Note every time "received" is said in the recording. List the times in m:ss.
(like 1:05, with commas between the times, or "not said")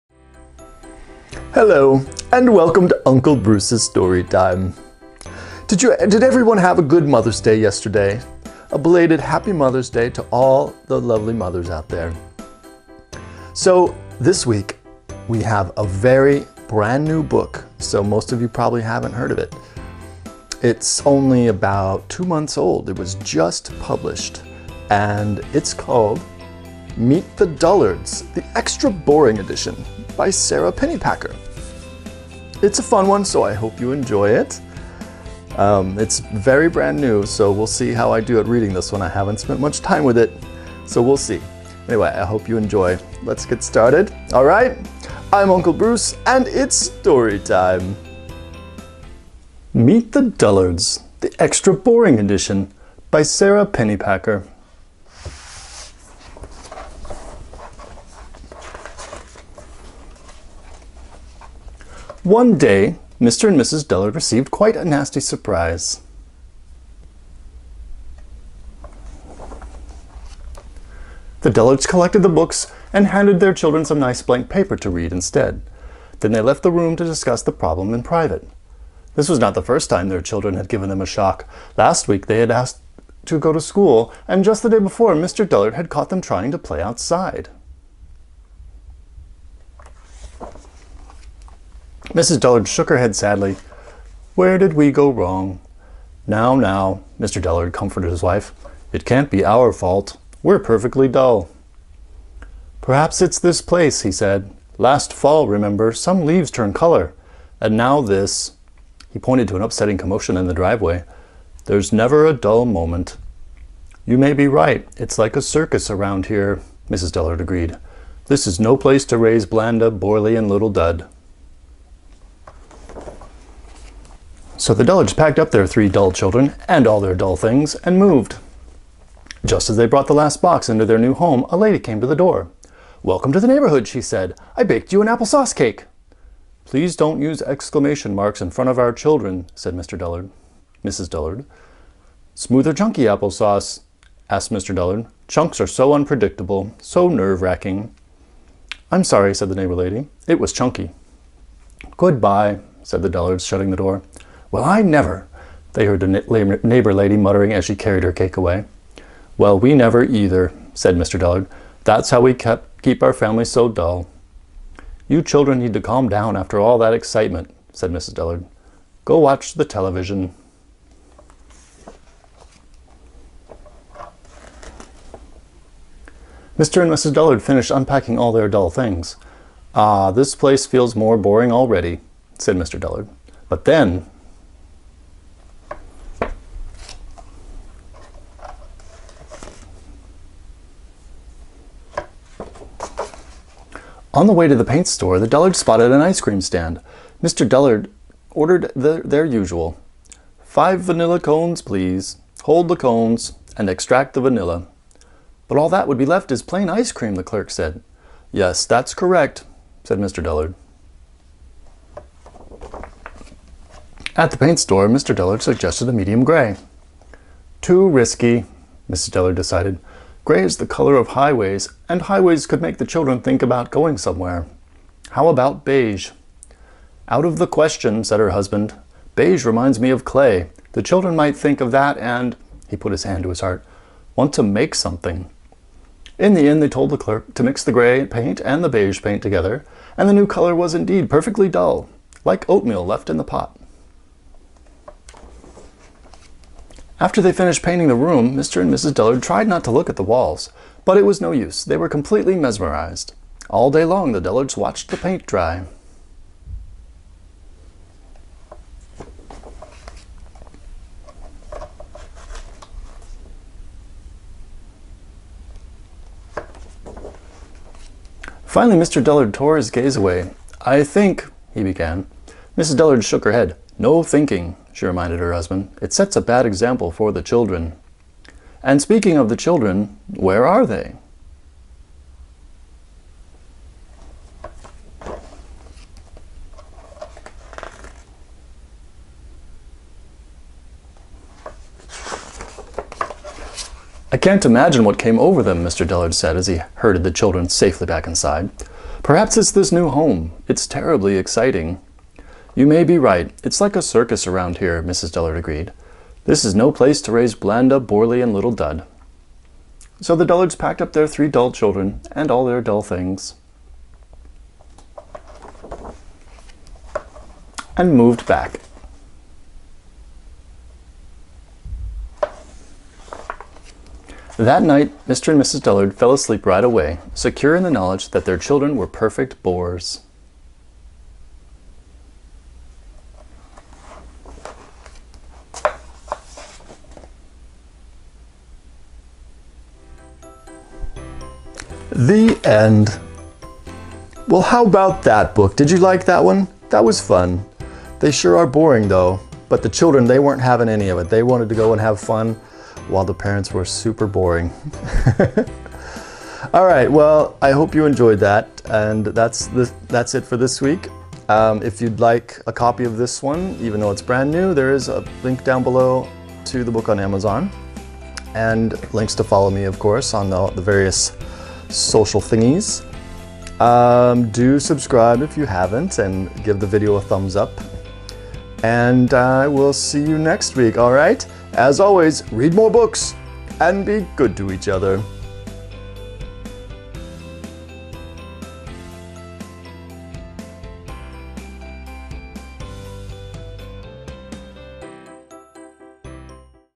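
1:04.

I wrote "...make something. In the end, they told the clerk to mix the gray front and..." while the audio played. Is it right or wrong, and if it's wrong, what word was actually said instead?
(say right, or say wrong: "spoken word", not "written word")
wrong: "paint", not "front".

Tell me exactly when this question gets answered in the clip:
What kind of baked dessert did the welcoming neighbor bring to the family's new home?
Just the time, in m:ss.
2:15.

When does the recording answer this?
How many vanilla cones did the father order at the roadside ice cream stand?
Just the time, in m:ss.
3:20.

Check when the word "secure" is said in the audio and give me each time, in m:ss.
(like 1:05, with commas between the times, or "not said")
5:27.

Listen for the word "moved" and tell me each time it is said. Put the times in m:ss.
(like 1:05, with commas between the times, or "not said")
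2:07, 5:17.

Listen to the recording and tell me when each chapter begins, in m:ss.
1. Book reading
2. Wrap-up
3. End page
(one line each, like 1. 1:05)
1. 0:49
2. 5:40
3. 6:27.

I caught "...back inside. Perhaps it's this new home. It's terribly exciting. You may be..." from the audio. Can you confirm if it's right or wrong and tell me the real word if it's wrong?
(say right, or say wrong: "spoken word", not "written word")
right.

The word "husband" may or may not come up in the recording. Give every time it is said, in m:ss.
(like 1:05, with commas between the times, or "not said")
3:48, 4:35.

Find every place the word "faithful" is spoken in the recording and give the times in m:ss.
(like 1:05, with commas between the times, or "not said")
not said.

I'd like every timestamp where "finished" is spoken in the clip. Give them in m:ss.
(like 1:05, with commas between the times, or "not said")
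2:57, 4:07.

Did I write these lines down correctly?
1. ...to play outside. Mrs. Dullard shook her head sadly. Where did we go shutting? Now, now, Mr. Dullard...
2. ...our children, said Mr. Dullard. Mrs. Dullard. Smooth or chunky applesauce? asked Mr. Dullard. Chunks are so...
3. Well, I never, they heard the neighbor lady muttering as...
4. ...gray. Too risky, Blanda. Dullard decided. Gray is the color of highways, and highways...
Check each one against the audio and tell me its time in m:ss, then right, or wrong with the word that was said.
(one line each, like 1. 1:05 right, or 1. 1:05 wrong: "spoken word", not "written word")
1. 1:26 wrong: "wrong", not "shutting"
2. 2:18 right
3. 2:34 right
4. 3:36 wrong: "Mrs", not "Blanda".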